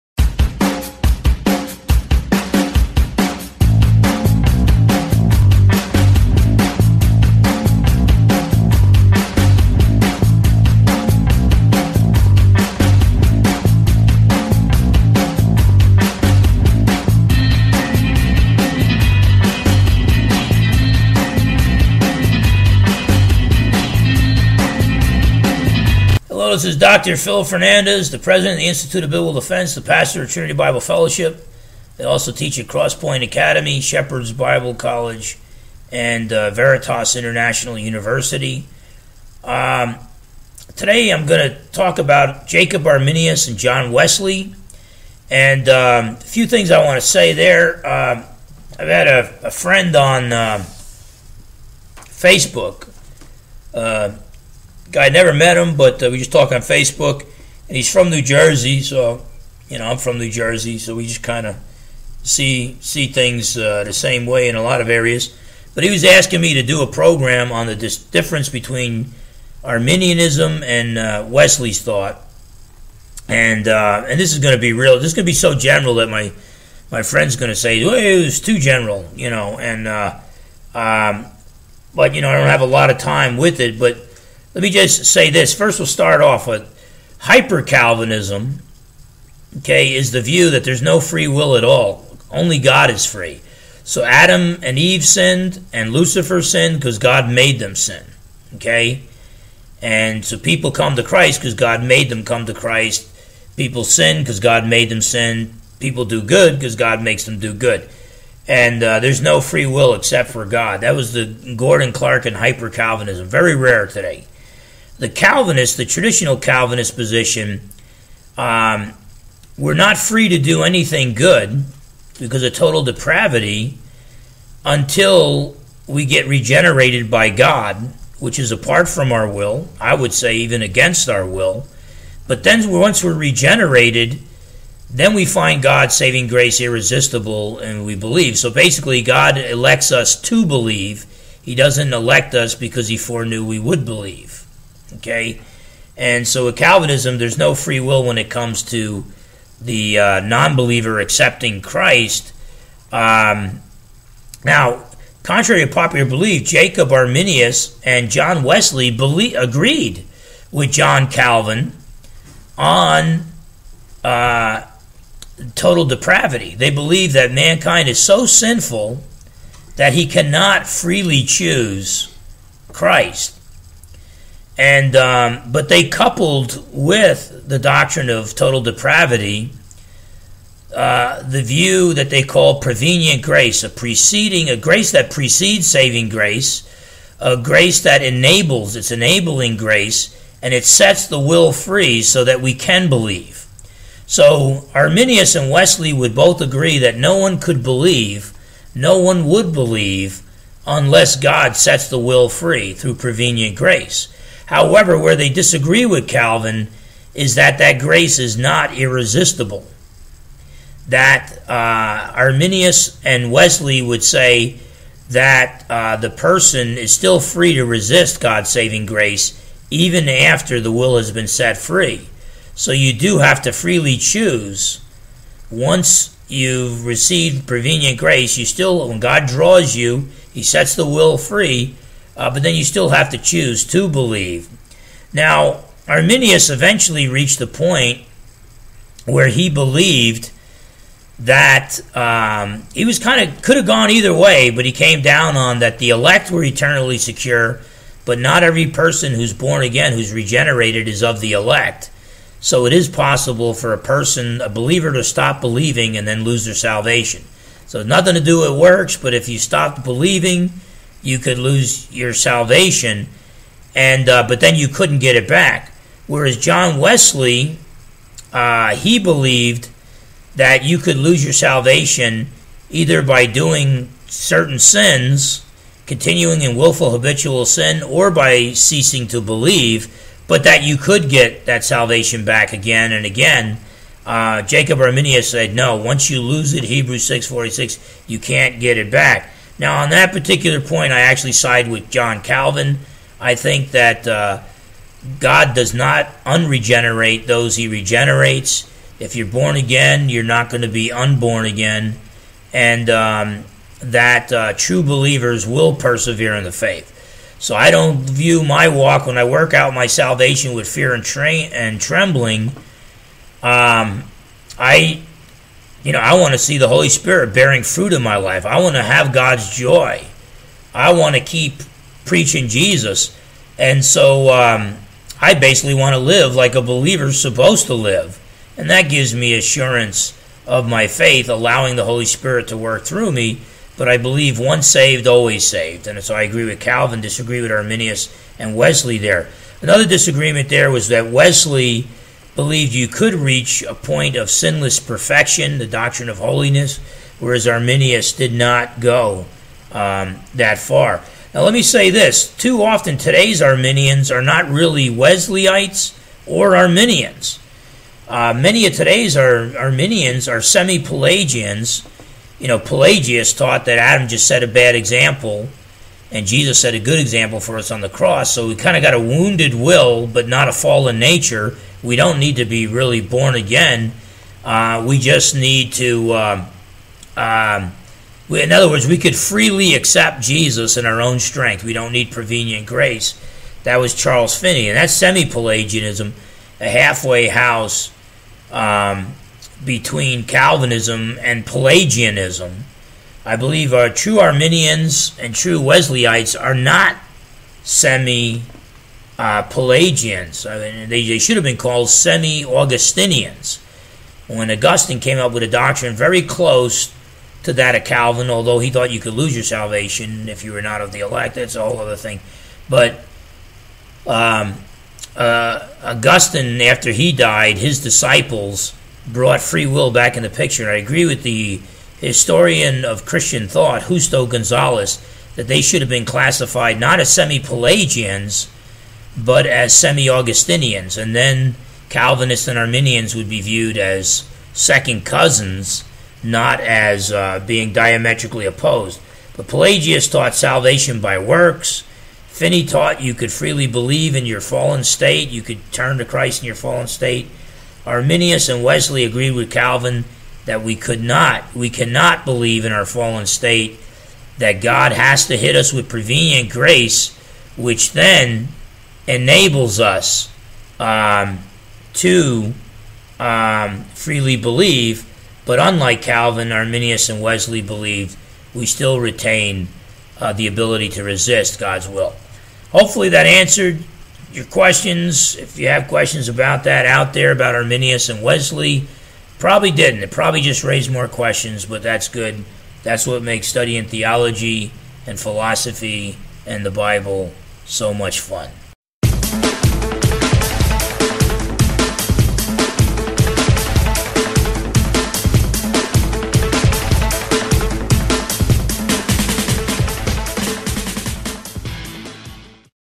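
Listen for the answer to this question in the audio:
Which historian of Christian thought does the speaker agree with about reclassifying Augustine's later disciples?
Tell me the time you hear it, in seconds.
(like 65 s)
423 s.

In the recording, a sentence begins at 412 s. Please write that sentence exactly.
But um, uh, Augustine, after he died, his disciples brought free will back in the picture.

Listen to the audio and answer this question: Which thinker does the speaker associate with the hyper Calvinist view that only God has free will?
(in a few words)
Gordon Clark.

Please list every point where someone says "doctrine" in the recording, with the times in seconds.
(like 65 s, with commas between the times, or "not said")
177 s, 345 s, 405 s.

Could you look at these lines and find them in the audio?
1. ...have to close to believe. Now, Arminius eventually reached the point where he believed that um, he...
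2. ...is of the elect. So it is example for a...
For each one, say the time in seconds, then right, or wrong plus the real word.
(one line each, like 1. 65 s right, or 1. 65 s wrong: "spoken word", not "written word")
1. 232 s wrong: "choose", not "close"
2. 250 s wrong: "possible", not "example".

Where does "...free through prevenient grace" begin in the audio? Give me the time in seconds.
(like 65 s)
202 s.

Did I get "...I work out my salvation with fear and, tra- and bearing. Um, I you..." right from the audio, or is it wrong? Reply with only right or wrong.
wrong.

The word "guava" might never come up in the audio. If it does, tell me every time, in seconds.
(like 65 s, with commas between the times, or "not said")
not said.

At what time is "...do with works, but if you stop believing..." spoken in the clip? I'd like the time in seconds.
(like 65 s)
258 s.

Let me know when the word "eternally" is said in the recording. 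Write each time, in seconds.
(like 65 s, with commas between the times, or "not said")
246 s.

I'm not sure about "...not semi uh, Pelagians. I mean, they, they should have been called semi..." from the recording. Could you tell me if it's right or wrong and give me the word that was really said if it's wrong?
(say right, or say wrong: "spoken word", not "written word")
right.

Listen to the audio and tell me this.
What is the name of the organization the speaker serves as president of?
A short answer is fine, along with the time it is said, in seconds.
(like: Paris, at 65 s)
Institute of Biblical Defense, at 28 s.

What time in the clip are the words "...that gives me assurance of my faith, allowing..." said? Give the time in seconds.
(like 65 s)
328 s.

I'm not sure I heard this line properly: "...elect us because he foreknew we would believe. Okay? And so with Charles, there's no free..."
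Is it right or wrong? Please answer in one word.
wrong.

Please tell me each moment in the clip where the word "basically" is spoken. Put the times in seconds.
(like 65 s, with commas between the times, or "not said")
138 s, 325 s.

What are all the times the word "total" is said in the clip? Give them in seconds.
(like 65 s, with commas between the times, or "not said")
122 s, 165 s, 178 s.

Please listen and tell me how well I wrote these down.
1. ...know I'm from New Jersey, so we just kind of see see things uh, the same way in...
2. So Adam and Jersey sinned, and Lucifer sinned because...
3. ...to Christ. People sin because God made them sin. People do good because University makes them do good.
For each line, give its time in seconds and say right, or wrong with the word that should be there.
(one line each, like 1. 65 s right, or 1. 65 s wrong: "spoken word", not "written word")
1. 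59 s right
2. 93 s wrong: "Eve", not "Jersey"
3. 102 s wrong: "God", not "University".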